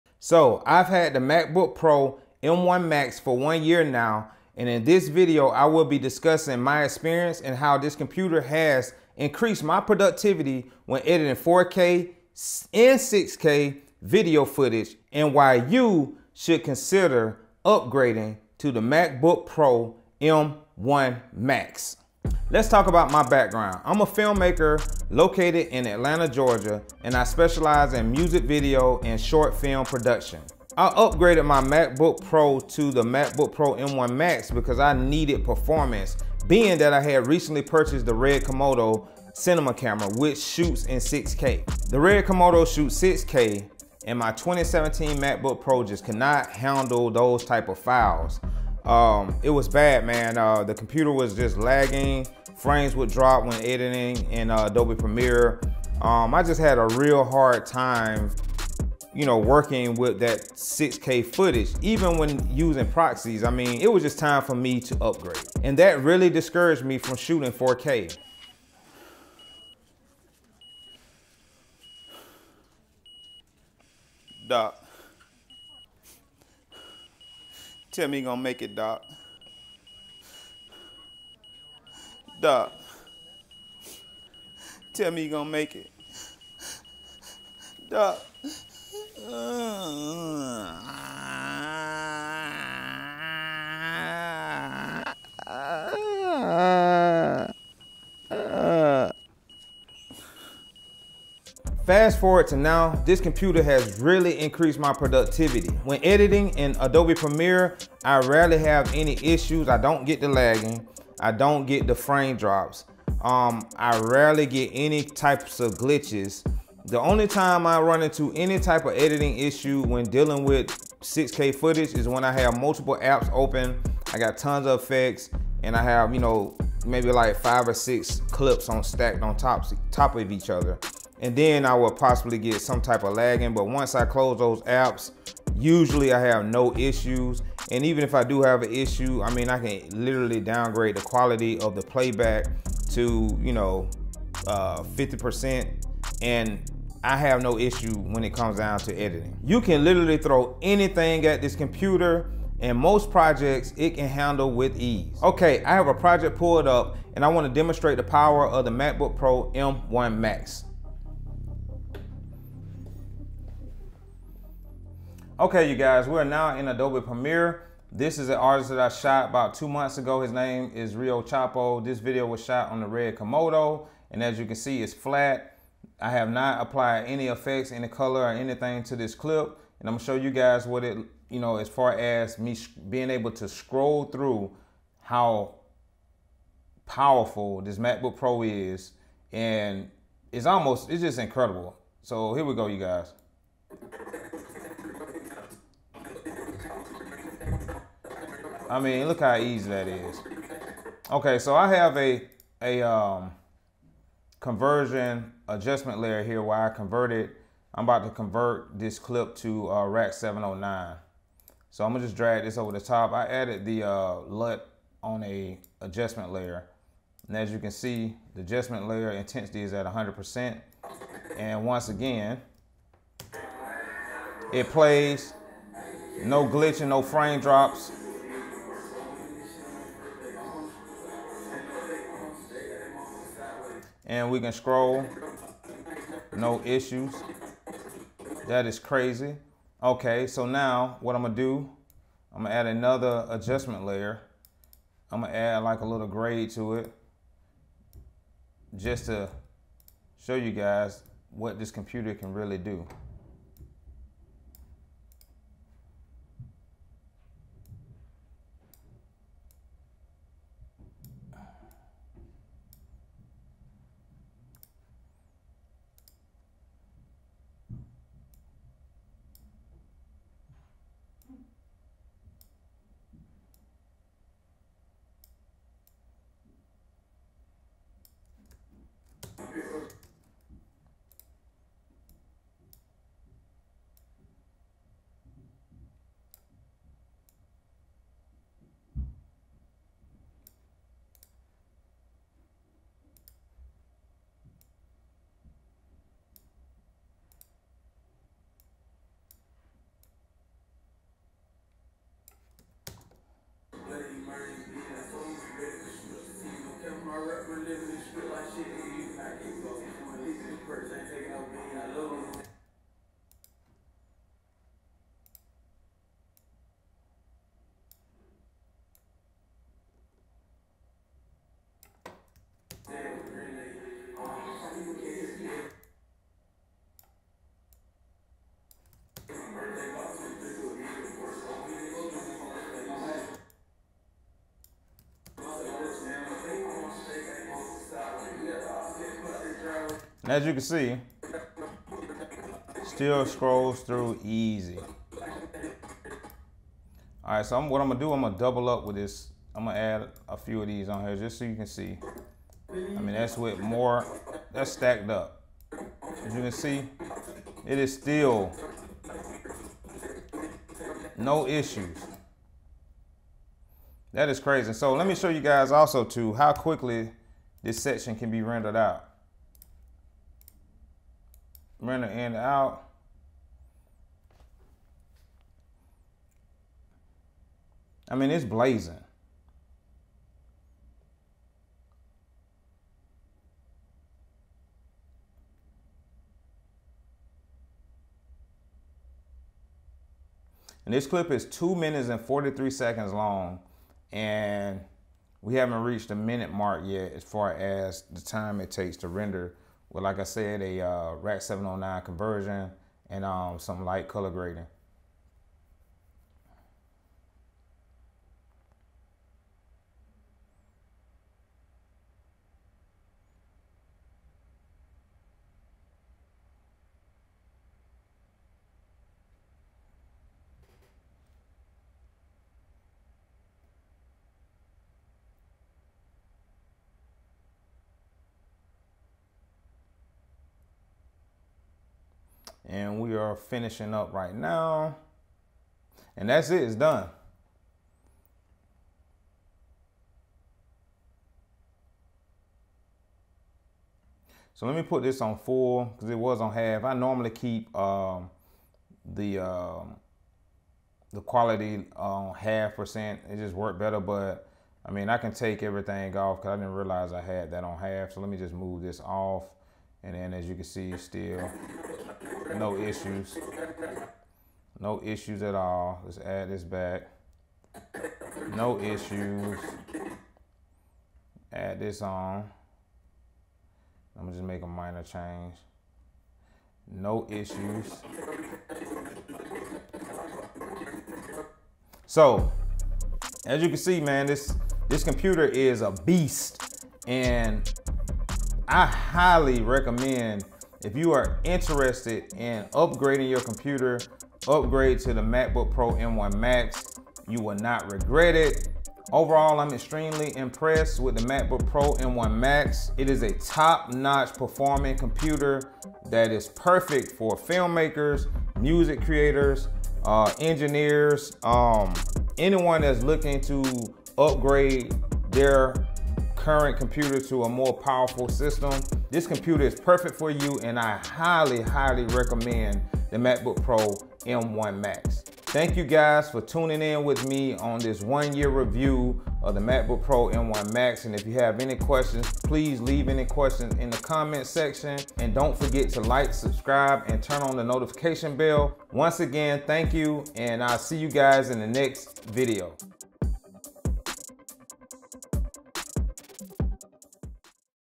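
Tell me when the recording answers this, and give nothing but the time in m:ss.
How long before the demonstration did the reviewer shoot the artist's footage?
2:49.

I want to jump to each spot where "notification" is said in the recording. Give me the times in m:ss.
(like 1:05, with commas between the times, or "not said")
8:57.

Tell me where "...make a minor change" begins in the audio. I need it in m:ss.
7:54.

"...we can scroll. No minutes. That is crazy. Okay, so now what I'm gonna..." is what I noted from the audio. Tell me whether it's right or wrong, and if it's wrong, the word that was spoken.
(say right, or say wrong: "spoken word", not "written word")
wrong: "issues", not "minutes".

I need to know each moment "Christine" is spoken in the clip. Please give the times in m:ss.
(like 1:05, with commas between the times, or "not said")
not said.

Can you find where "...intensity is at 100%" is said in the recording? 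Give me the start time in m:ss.
3:39.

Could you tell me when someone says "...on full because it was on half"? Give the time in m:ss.
7:25.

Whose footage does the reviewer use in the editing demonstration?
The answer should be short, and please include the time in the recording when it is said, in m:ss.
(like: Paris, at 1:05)
Rio Chapo, at 2:50.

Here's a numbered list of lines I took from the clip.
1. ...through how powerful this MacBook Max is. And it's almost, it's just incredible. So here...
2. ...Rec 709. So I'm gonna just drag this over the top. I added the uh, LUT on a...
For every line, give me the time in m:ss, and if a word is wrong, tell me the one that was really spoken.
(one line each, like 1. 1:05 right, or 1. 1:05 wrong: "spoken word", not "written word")
1. 3:04 wrong: "Pro", not "Max"
2. 3:29 right.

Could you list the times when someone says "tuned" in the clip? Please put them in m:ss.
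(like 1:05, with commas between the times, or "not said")
not said.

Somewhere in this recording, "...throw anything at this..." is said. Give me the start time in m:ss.
2:30.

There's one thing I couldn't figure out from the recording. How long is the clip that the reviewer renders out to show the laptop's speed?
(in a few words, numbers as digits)
2 minutes 43 seconds.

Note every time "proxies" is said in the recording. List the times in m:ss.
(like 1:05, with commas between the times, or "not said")
1:02.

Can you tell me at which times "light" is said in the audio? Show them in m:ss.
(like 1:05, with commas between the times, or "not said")
6:43.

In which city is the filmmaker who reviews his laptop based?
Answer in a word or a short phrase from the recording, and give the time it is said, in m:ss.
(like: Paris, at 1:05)
Atlanta, Georgia, at 0:25.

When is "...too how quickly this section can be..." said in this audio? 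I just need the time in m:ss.
6:06.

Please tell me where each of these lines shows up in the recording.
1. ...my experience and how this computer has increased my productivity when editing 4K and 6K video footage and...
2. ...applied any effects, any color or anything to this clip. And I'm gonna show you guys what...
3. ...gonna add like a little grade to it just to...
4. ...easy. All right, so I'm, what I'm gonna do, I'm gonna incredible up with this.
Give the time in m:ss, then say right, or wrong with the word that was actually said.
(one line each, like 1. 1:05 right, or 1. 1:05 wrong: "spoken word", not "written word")
1. 0:06 right
2. 2:56 right
3. 4:05 right
4. 5:44 wrong: "double", not "incredible".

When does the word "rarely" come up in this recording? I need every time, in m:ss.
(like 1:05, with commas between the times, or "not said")
1:48, 1:54.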